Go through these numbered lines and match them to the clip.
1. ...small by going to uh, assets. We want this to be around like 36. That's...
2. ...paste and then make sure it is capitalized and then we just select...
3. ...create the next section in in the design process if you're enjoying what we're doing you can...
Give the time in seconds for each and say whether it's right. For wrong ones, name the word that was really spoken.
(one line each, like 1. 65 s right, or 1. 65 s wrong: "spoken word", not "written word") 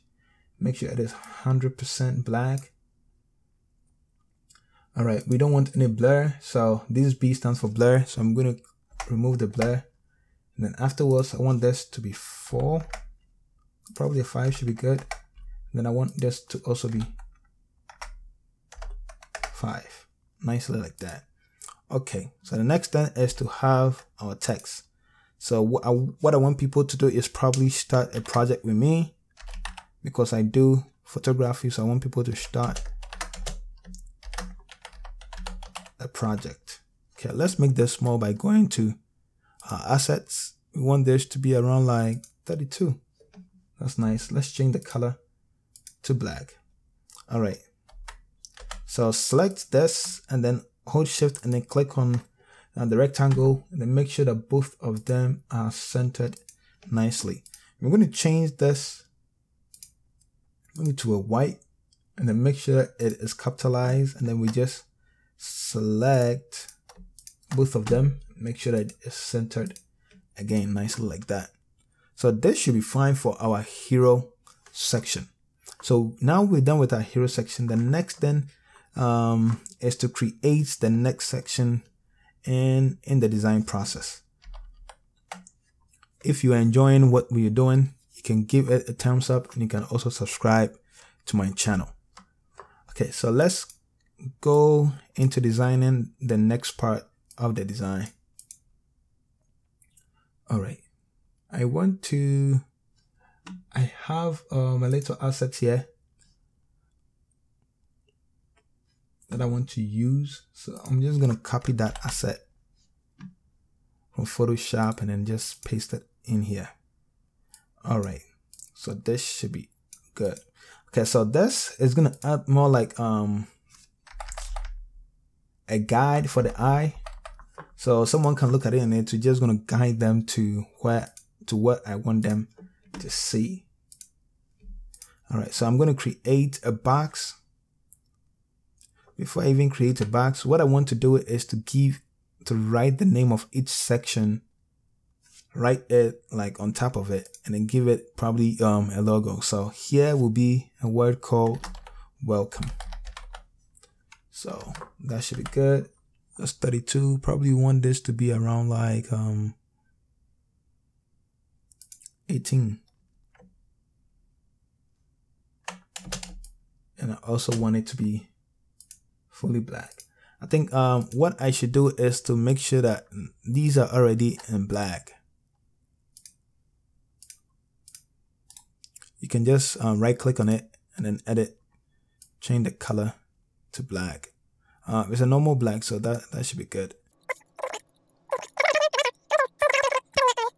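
1. 37 s wrong: "32", not "36"
2. 61 s wrong: "white", not "paste"
3. 80 s right.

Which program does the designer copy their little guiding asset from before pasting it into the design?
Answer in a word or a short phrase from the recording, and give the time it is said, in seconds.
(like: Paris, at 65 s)
Photoshop, at 114 s.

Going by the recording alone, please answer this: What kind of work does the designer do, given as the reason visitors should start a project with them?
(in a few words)
Photography.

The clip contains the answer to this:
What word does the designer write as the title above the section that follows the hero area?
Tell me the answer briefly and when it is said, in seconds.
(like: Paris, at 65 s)
Welcome, at 152 s.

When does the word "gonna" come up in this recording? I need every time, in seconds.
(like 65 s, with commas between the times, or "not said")
111 s, 121 s.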